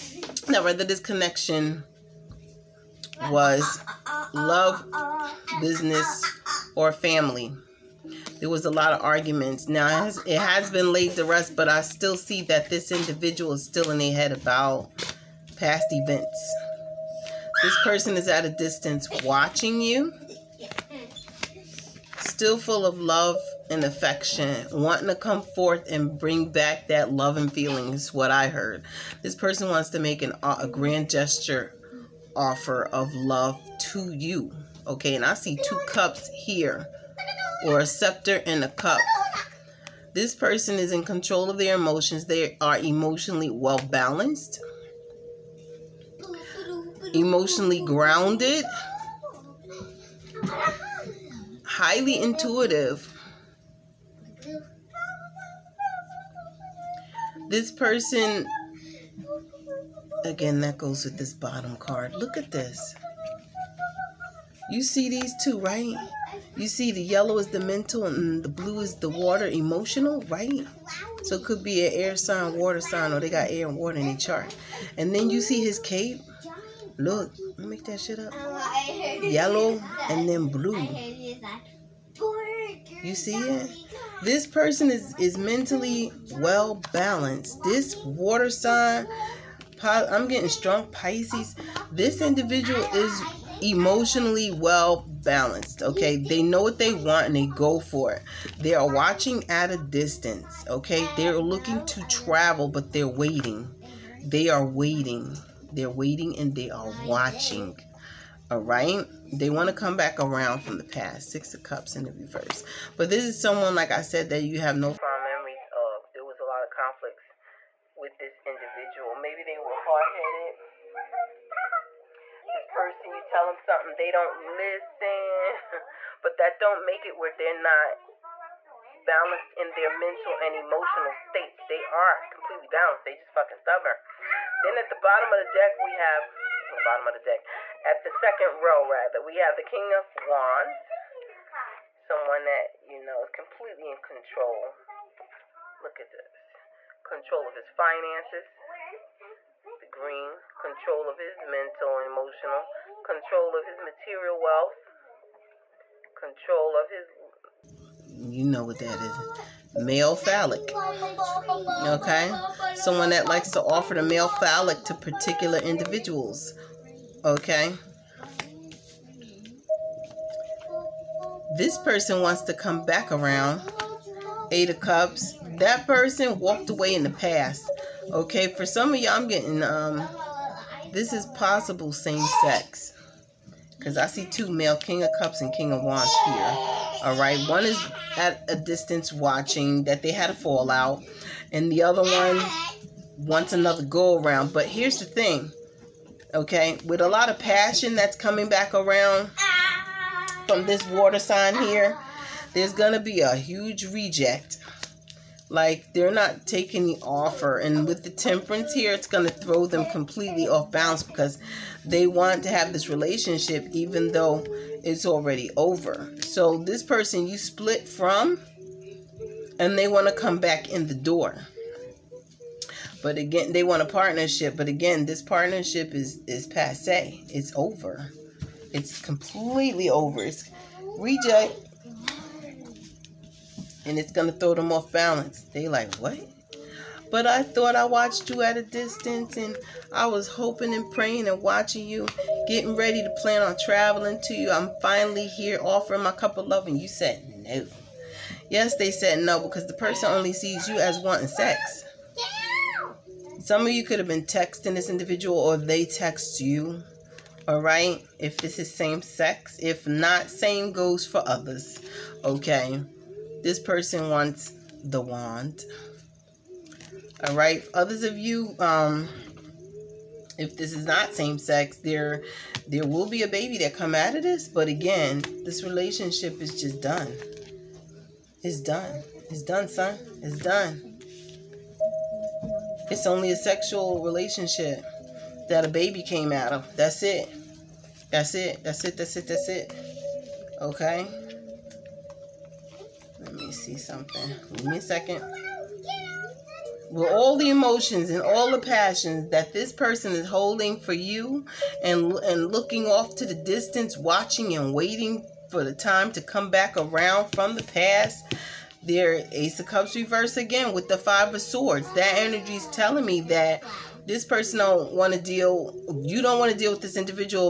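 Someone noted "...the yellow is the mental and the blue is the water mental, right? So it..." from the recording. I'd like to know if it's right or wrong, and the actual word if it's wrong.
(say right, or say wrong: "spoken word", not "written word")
wrong: "emotional", not "mental".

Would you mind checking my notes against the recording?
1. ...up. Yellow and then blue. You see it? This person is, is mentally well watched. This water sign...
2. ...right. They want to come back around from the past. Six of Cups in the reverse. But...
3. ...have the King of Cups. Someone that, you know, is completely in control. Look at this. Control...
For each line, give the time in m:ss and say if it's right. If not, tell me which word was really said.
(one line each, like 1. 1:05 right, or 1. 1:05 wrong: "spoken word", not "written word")
1. 1:18 wrong: "balanced", not "watched"
2. 1:48 right
3. 2:19 wrong: "Wands", not "Cups".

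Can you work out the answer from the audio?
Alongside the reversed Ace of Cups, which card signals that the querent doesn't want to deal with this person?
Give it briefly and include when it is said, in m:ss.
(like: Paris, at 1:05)
Five of Swords, at 5:10.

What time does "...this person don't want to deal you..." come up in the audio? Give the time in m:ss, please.
5:14.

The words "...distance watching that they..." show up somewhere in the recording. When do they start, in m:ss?
3:08.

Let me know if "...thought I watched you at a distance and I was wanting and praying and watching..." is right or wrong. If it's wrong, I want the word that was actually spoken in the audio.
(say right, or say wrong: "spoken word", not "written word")
wrong: "hoping", not "wanting".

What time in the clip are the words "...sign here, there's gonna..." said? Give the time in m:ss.
3:21.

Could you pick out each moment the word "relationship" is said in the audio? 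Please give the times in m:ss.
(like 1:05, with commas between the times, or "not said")
3:32, 4:35, 4:44.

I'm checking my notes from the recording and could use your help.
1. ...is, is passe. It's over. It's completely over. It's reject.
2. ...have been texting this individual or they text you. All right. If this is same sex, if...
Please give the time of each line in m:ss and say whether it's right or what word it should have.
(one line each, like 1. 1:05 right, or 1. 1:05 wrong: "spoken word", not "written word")
1. 3:45 right
2. 4:13 right.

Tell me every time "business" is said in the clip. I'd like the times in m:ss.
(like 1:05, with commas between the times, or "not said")
0:05.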